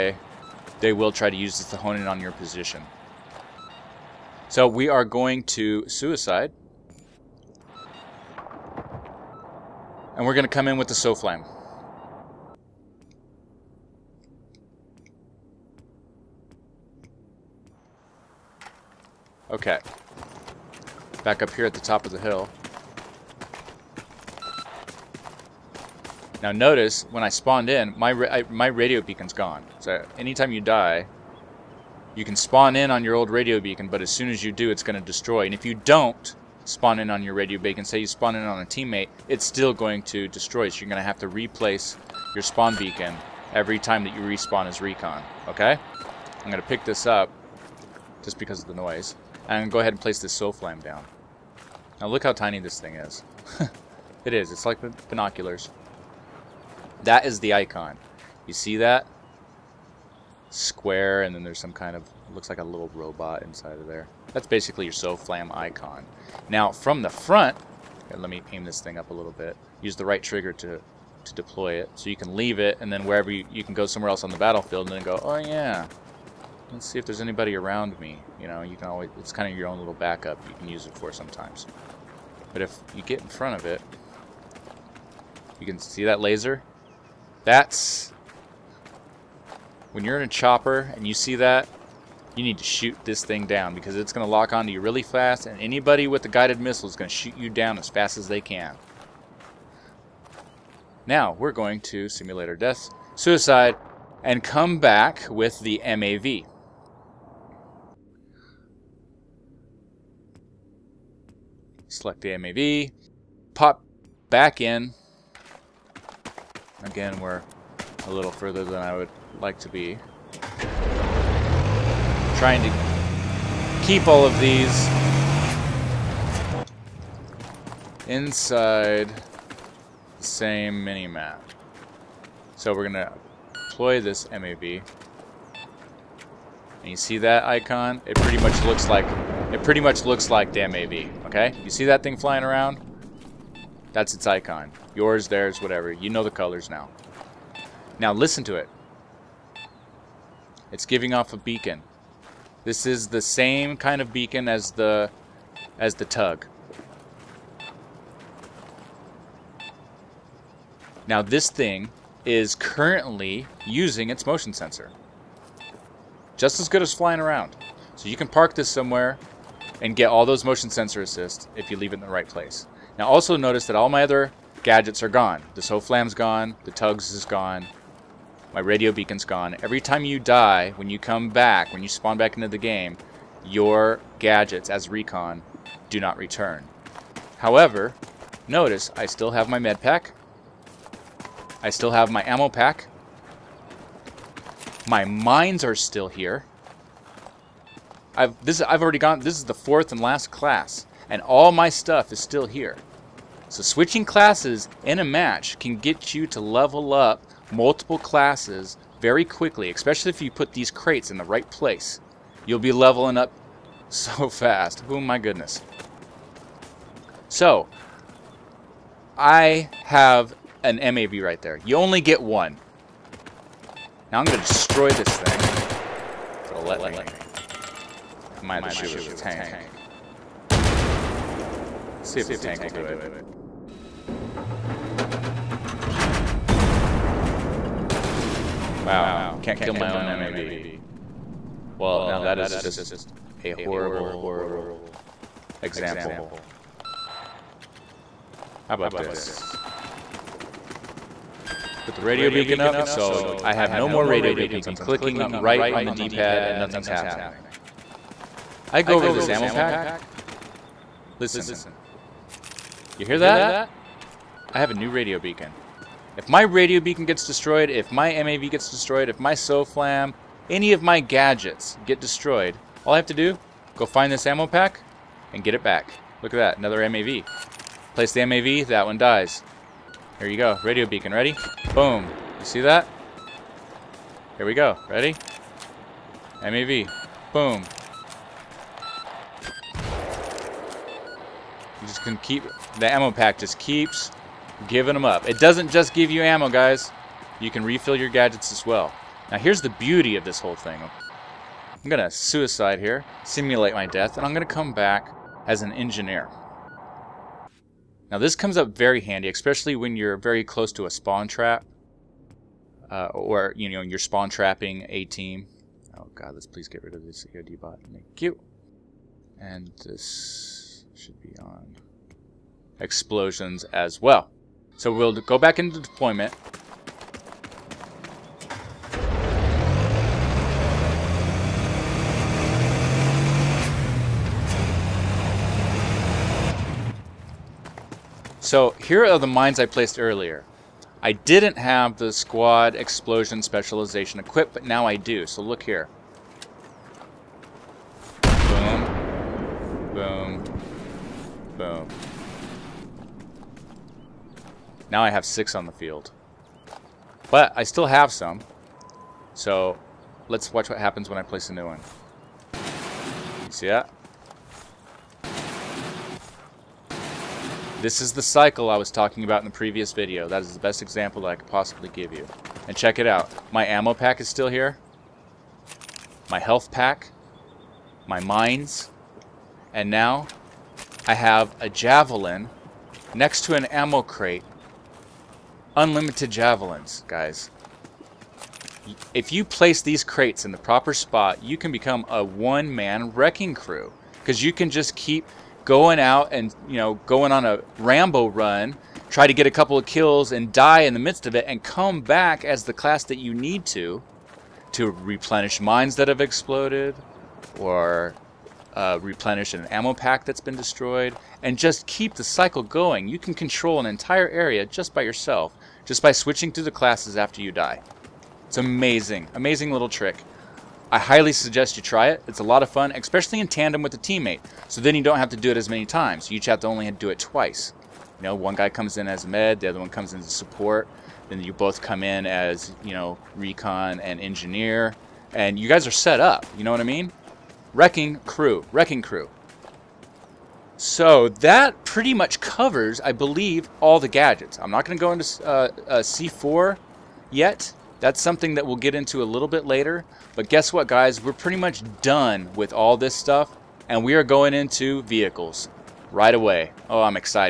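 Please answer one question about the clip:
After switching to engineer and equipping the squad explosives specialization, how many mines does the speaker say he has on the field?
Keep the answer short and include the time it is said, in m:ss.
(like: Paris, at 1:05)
6, at 5:55.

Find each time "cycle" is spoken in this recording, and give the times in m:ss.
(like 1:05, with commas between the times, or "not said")
6:08, 6:52.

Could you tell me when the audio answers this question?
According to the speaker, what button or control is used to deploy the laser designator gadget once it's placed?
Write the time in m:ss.
1:10.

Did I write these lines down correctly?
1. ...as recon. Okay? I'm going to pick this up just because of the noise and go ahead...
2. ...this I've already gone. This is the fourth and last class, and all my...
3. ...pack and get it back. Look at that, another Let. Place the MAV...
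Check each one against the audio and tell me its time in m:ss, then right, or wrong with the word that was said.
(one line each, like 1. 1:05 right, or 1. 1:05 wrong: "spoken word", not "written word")
1. 0:44 right
2. 3:18 right
3. 4:34 wrong: "MAV", not "Let".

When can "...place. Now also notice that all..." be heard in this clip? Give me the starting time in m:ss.
2:52.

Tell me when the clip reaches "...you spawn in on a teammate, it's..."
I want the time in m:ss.
0:37.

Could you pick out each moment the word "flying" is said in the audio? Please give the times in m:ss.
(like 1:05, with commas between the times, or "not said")
2:22, 2:46.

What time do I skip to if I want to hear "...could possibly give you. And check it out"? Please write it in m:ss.
6:11.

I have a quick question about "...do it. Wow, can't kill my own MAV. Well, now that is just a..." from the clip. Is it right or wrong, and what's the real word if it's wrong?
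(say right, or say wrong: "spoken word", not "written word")
right.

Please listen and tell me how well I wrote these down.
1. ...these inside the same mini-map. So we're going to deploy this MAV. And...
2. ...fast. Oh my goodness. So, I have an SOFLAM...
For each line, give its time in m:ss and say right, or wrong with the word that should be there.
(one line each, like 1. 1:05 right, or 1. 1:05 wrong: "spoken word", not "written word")
1. 2:04 right
2. 3:34 wrong: "MAV", not "SOFLAM".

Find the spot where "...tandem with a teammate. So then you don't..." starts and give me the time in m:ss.
7:03.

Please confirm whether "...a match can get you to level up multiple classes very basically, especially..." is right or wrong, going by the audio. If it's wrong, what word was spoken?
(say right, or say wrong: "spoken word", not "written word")
wrong: "quickly", not "basically".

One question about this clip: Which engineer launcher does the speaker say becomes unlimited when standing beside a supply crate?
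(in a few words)
Javelin.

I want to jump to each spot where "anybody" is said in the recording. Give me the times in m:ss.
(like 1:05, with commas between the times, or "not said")
1:17, 1:35.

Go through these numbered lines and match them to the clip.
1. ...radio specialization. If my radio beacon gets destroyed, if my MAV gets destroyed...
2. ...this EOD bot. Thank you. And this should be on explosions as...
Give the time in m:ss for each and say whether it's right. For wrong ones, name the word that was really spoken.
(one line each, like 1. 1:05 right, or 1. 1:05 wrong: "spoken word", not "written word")
1. 4:24 wrong: "beacon", not "specialization"
2. 5:17 right.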